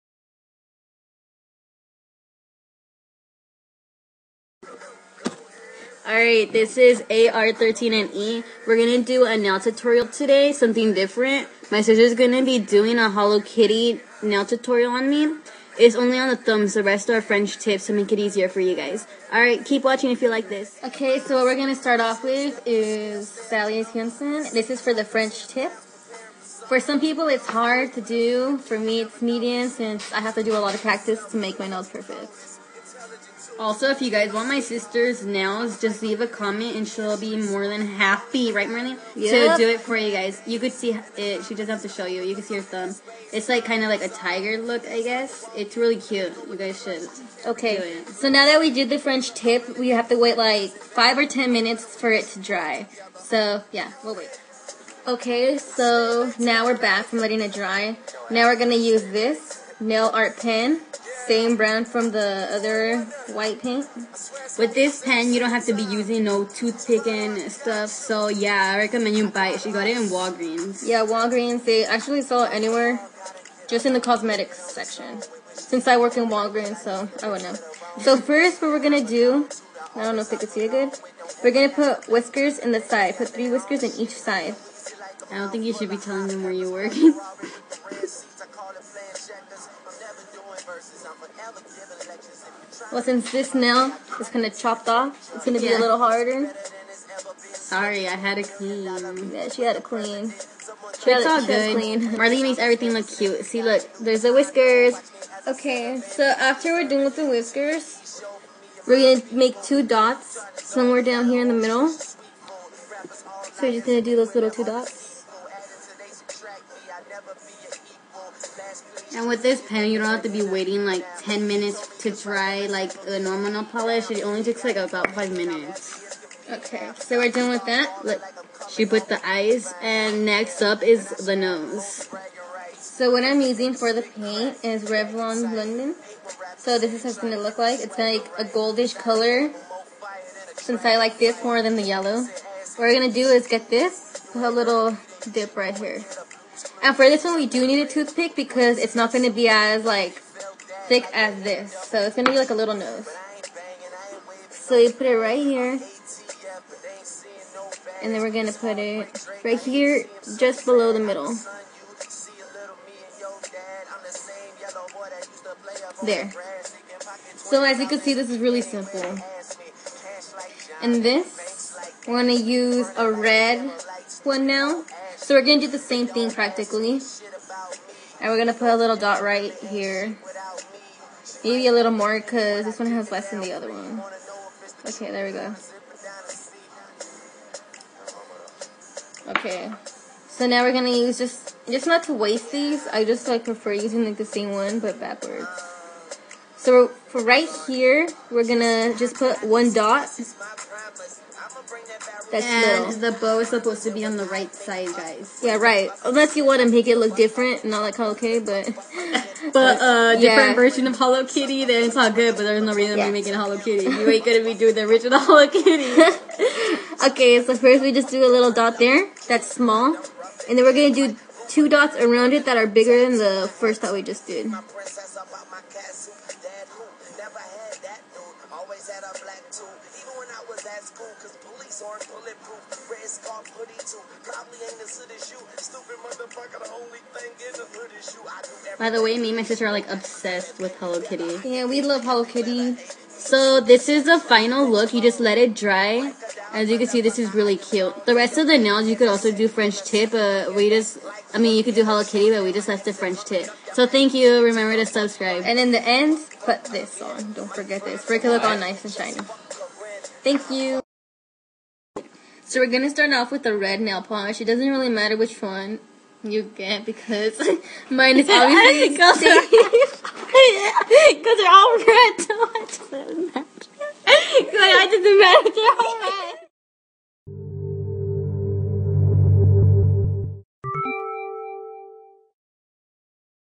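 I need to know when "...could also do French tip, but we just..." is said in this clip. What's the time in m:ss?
4:08.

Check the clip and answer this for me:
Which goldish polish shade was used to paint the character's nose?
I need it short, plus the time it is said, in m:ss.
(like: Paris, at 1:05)
Revlon London, at 2:14.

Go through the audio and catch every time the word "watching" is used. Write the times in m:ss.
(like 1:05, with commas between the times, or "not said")
0:19.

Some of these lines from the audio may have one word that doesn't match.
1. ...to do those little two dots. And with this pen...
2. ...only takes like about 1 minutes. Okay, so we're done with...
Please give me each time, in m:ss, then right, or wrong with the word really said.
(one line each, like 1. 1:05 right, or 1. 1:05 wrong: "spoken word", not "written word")
1. 1:53 right
2. 2:04 wrong: "5", not "1".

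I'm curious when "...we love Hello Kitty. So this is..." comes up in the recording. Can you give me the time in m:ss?
4:01.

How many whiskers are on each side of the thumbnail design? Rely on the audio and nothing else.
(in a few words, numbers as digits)
3.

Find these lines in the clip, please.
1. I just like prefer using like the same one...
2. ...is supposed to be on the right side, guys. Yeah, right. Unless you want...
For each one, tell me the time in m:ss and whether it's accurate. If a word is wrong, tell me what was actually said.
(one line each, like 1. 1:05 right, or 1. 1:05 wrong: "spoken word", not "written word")
1. 3:12 right
2. 3:23 right.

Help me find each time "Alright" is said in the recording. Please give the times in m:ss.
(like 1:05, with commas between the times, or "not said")
0:06, 0:19.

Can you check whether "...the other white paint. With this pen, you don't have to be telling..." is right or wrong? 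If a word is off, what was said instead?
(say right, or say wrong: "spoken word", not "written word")
wrong: "using", not "telling".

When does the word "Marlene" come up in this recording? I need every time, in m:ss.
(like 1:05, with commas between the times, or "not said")
0:38, 1:42.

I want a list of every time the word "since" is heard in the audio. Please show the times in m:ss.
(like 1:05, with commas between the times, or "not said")
0:29, 1:15, 1:33, 2:20.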